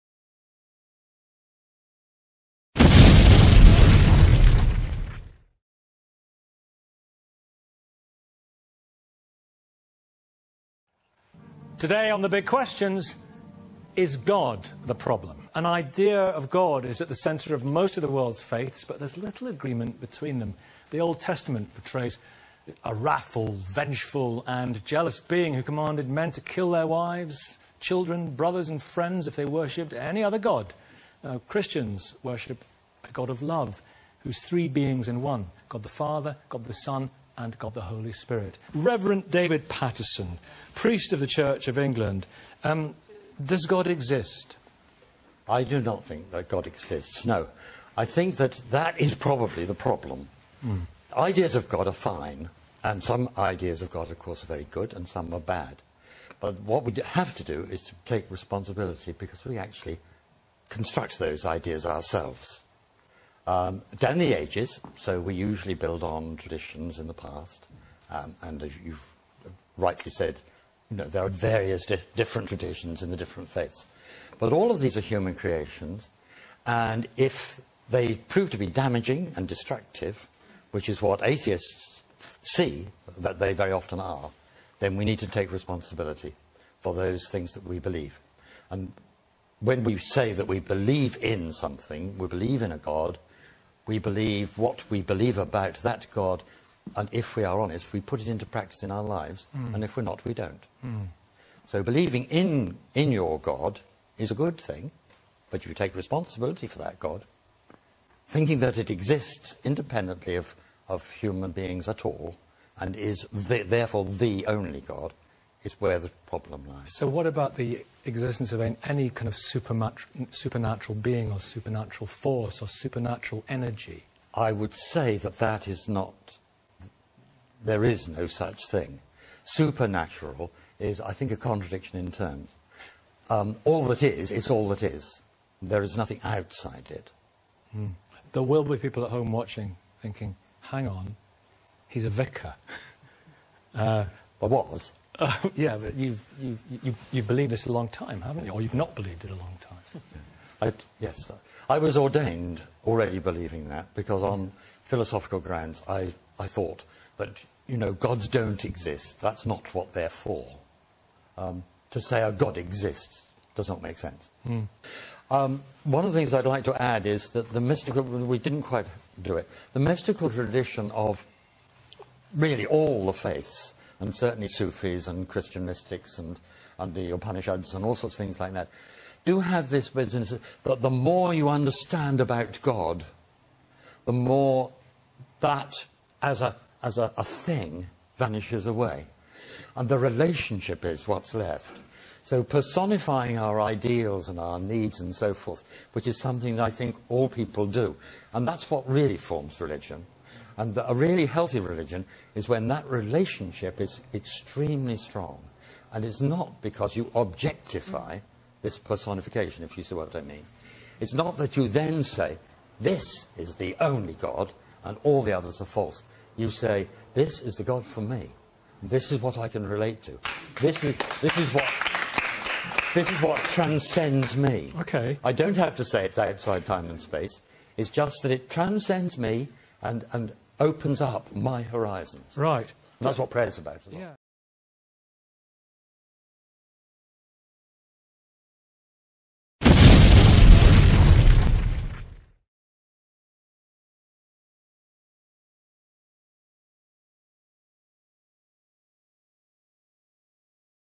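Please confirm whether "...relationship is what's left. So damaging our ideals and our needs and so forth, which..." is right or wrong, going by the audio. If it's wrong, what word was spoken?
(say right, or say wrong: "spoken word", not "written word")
wrong: "personifying", not "damaging".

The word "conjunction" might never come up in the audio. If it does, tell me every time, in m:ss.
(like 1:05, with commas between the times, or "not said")
not said.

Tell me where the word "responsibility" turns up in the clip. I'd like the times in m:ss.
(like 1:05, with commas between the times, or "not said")
0:58, 1:25, 1:45.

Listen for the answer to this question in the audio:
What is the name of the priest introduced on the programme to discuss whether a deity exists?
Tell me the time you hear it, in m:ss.
0:39.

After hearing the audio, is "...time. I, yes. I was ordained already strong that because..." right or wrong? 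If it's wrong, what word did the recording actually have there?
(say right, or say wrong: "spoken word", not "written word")
wrong: "believing", not "strong".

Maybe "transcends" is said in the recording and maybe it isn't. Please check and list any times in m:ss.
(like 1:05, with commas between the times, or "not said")
3:43, 3:48.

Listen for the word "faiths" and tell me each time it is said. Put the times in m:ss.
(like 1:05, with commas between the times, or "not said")
0:18, 1:13, 2:53.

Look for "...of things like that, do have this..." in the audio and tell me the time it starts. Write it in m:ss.
2:58.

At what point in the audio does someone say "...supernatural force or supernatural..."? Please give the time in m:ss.
2:01.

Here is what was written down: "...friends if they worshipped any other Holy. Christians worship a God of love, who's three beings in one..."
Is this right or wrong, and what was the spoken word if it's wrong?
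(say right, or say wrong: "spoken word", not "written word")
wrong: "God", not "Holy".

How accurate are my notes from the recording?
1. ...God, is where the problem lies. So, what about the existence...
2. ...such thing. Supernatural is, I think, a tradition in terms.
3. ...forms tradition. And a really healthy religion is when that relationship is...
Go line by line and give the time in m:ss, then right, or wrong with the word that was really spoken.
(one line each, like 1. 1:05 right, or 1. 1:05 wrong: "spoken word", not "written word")
1. 1:54 right
2. 2:08 wrong: "contradiction", not "tradition"
3. 3:19 wrong: "religion", not "tradition".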